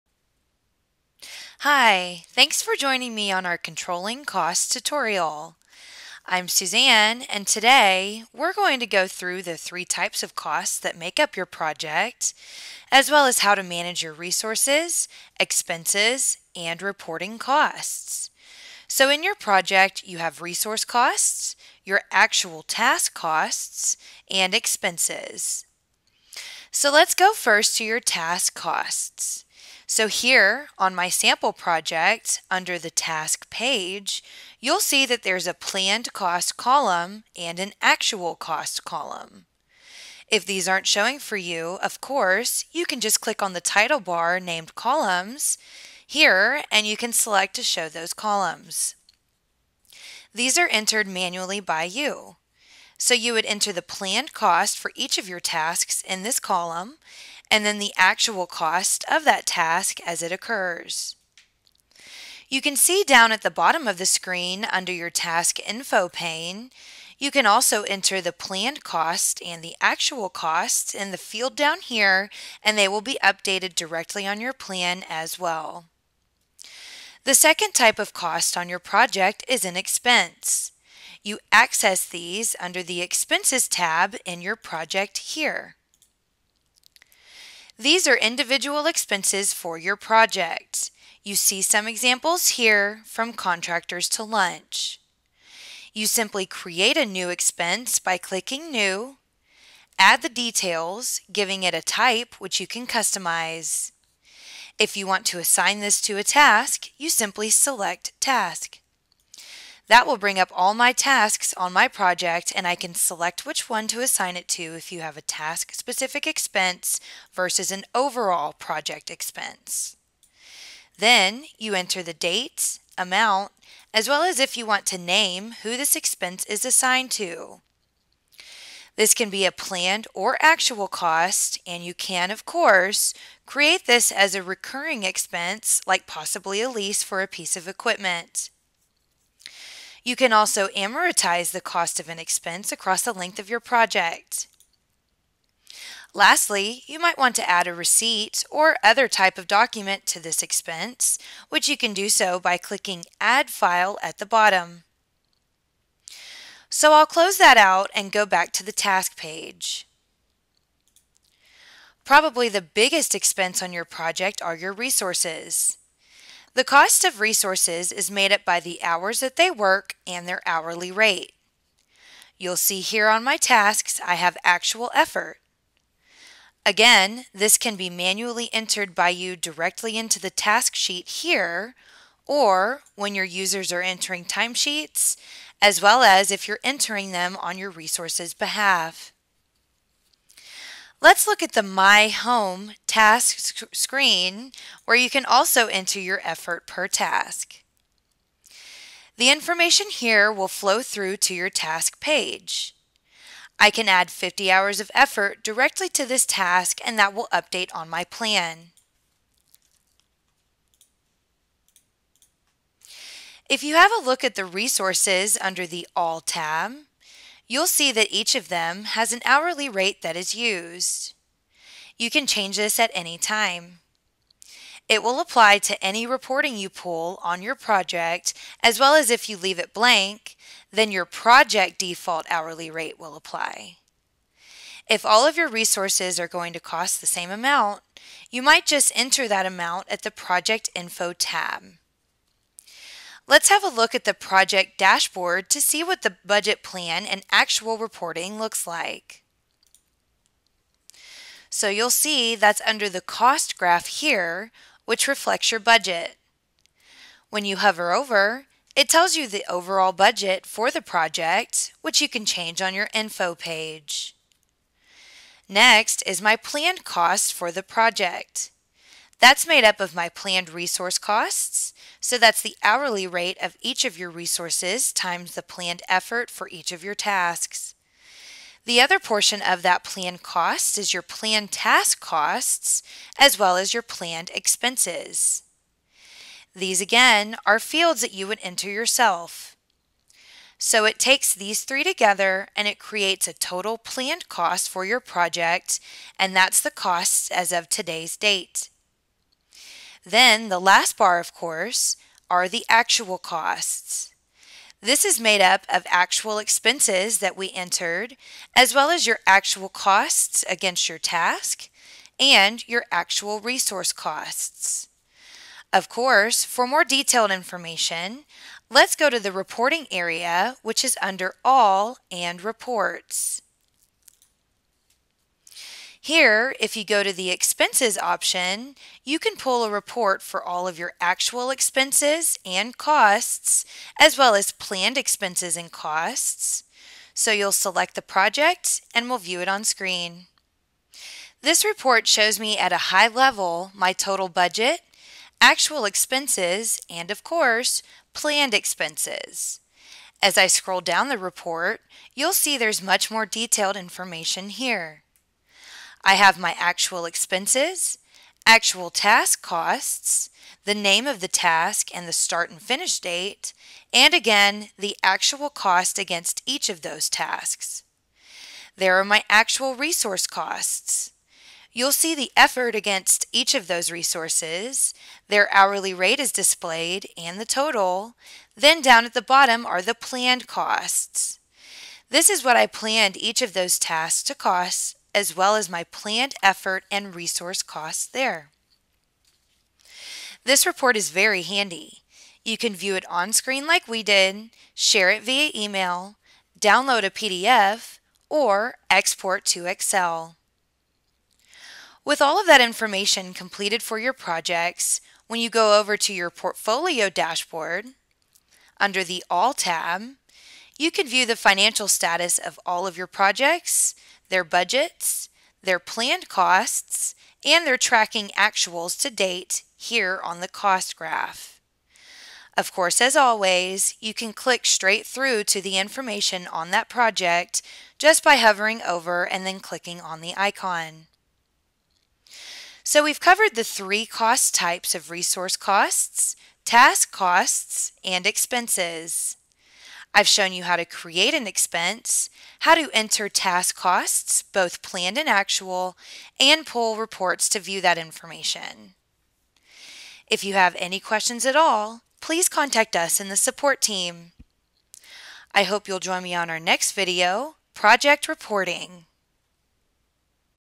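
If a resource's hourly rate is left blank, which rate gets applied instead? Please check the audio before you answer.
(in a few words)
Project default hourly rate.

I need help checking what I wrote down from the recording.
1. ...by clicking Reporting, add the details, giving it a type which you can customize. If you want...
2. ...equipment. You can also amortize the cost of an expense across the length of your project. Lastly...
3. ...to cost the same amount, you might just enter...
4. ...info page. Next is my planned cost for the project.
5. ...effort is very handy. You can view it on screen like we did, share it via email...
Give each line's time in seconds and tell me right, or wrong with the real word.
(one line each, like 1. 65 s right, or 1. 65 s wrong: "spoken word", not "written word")
1. 97 s wrong: "New", not "Reporting"
2. 137 s right
3. 236 s right
4. 262 s right
5. 390 s wrong: "report", not "effort".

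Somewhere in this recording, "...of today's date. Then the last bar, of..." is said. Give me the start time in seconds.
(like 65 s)
297 s.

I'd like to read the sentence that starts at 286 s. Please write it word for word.
These again are fields that you would enter yourself.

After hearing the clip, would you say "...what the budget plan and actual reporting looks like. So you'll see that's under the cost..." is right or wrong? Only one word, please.
right.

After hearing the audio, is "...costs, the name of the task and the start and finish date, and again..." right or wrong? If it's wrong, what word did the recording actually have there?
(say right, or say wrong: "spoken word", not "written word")
right.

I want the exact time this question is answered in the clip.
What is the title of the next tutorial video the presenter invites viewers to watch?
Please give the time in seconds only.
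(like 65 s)
457 s.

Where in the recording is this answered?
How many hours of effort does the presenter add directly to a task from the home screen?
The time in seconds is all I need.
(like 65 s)
204 s.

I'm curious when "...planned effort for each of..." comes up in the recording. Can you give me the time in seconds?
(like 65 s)
275 s.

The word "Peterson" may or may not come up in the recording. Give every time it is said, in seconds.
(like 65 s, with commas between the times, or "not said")
not said.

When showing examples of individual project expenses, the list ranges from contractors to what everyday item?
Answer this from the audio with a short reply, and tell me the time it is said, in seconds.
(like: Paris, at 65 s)
Lunch, at 94 s.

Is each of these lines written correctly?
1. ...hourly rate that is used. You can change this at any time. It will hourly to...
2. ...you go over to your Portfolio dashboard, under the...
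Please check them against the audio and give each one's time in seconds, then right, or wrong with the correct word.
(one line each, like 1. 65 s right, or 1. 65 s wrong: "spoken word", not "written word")
1. 219 s wrong: "apply", not "hourly"
2. 405 s right.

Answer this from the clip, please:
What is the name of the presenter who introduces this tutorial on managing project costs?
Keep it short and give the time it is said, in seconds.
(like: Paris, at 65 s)
Suzanne, at 6 s.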